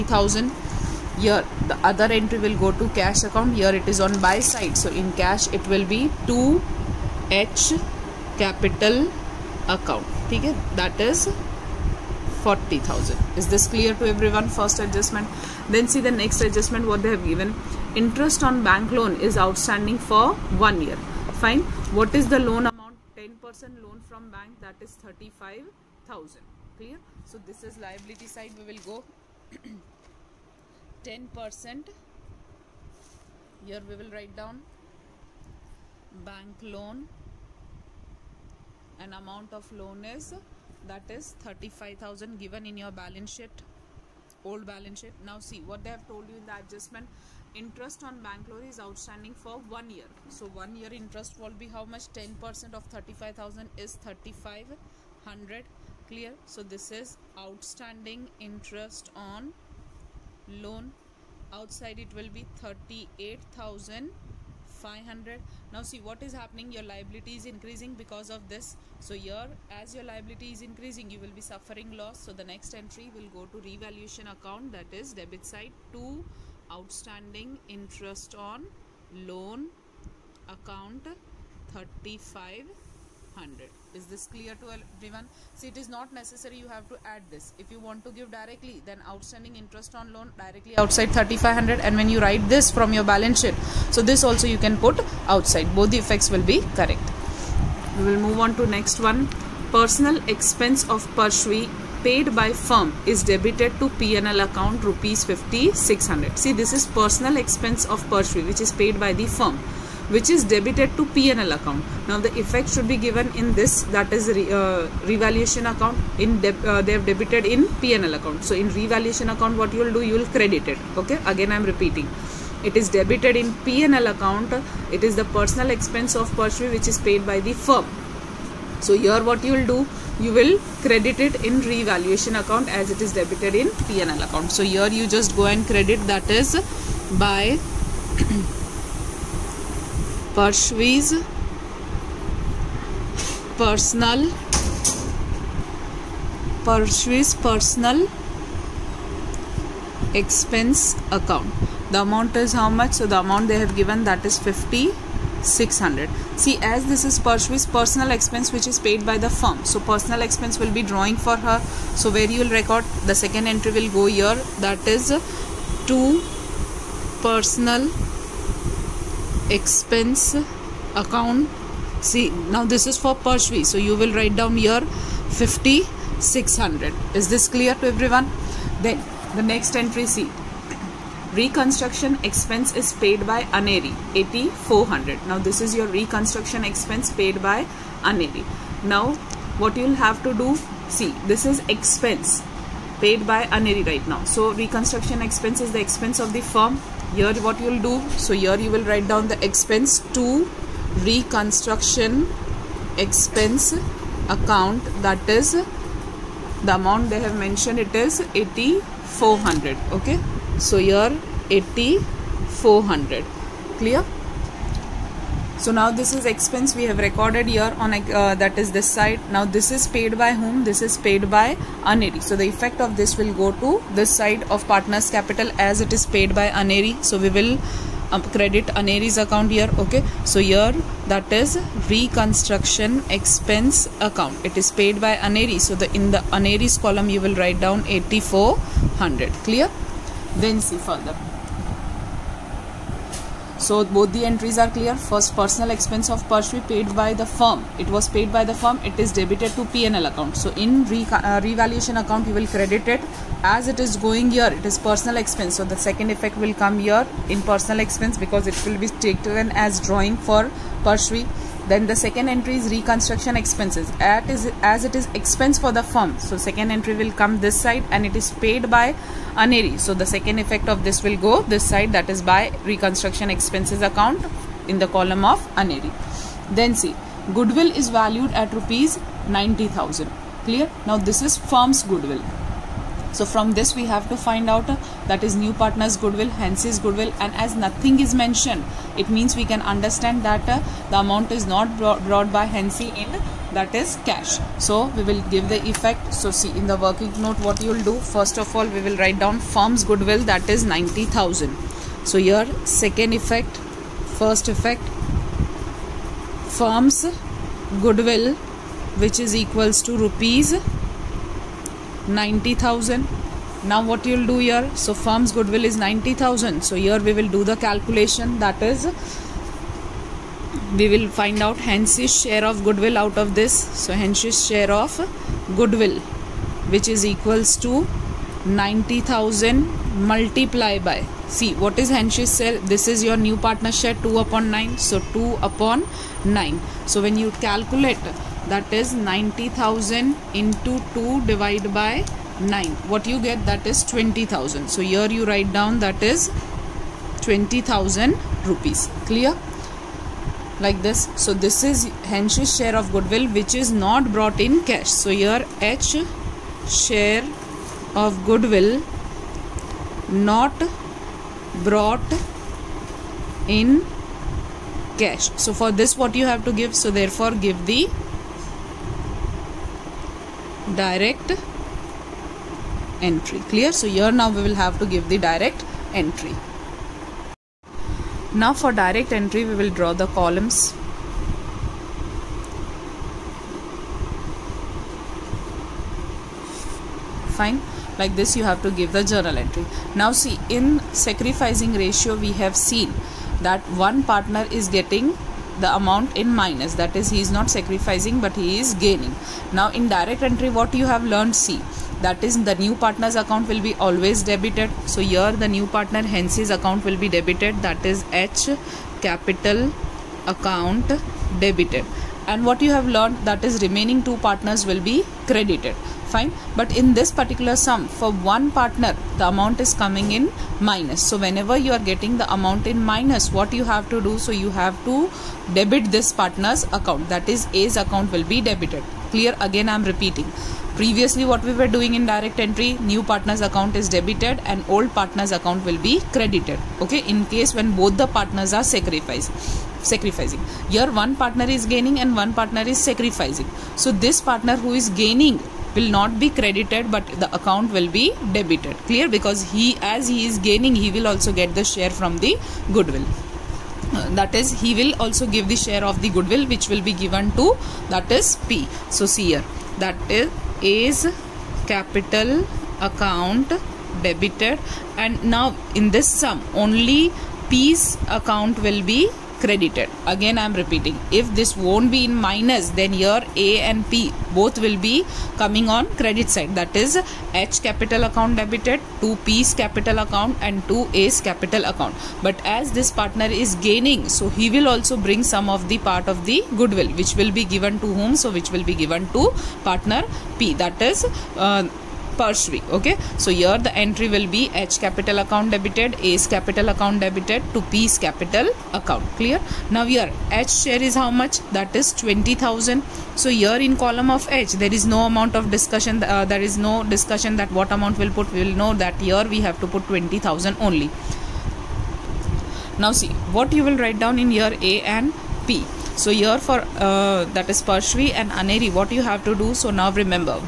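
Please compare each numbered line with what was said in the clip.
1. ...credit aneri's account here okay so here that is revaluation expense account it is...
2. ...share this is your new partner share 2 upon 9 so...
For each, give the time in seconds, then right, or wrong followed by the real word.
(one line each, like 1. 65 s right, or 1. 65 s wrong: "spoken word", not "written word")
1. 228 s wrong: "reconstruction", not "revaluation"
2. 332 s right.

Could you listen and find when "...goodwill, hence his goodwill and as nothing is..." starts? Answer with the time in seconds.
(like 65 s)
285 s.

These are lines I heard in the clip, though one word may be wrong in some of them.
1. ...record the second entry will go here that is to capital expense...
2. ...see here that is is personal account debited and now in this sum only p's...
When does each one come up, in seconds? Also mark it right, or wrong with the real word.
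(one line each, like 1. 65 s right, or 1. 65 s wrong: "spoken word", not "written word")
1. 162 s wrong: "personal", not "capital"
2. 459 s wrong: "capital", not "personal".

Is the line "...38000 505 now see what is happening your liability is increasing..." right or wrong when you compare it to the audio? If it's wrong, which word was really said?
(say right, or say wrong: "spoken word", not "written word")
wrong: "500", not "505".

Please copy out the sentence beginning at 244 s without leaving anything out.
First, personal expense of Parshvi paid by the firm.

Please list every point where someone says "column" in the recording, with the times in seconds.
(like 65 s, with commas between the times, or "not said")
236 s, 274 s, 380 s, 503 s.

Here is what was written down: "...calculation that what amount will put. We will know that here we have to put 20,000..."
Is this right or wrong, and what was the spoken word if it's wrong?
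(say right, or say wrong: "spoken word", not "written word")
wrong: "discussion", not "calculation".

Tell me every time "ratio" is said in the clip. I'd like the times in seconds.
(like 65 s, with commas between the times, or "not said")
391 s.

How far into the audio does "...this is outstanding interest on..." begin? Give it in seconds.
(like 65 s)
56 s.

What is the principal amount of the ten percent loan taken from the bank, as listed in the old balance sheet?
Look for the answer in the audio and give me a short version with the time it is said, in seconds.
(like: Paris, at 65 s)
35,000, at 23 s.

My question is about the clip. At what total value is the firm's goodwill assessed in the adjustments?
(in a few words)
90,000.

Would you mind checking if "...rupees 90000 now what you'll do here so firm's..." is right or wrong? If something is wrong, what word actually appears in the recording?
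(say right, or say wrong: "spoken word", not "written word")
right.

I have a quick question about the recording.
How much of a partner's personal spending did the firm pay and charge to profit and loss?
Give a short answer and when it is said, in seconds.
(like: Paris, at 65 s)
5,600, at 104 s.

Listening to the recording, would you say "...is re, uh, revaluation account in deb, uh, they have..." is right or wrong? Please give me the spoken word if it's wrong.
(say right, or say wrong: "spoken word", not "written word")
right.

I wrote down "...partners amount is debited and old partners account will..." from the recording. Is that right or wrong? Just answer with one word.
wrong.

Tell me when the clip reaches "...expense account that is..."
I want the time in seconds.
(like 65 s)
203 s.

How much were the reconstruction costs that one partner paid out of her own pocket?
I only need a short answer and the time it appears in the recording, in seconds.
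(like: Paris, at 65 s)
8,400, at 181 s.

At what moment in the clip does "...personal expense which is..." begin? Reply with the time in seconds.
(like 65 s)
157 s.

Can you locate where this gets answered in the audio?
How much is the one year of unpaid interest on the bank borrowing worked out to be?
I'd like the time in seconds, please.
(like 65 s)
52 s.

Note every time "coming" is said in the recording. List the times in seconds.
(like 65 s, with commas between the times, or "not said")
419 s, 475 s.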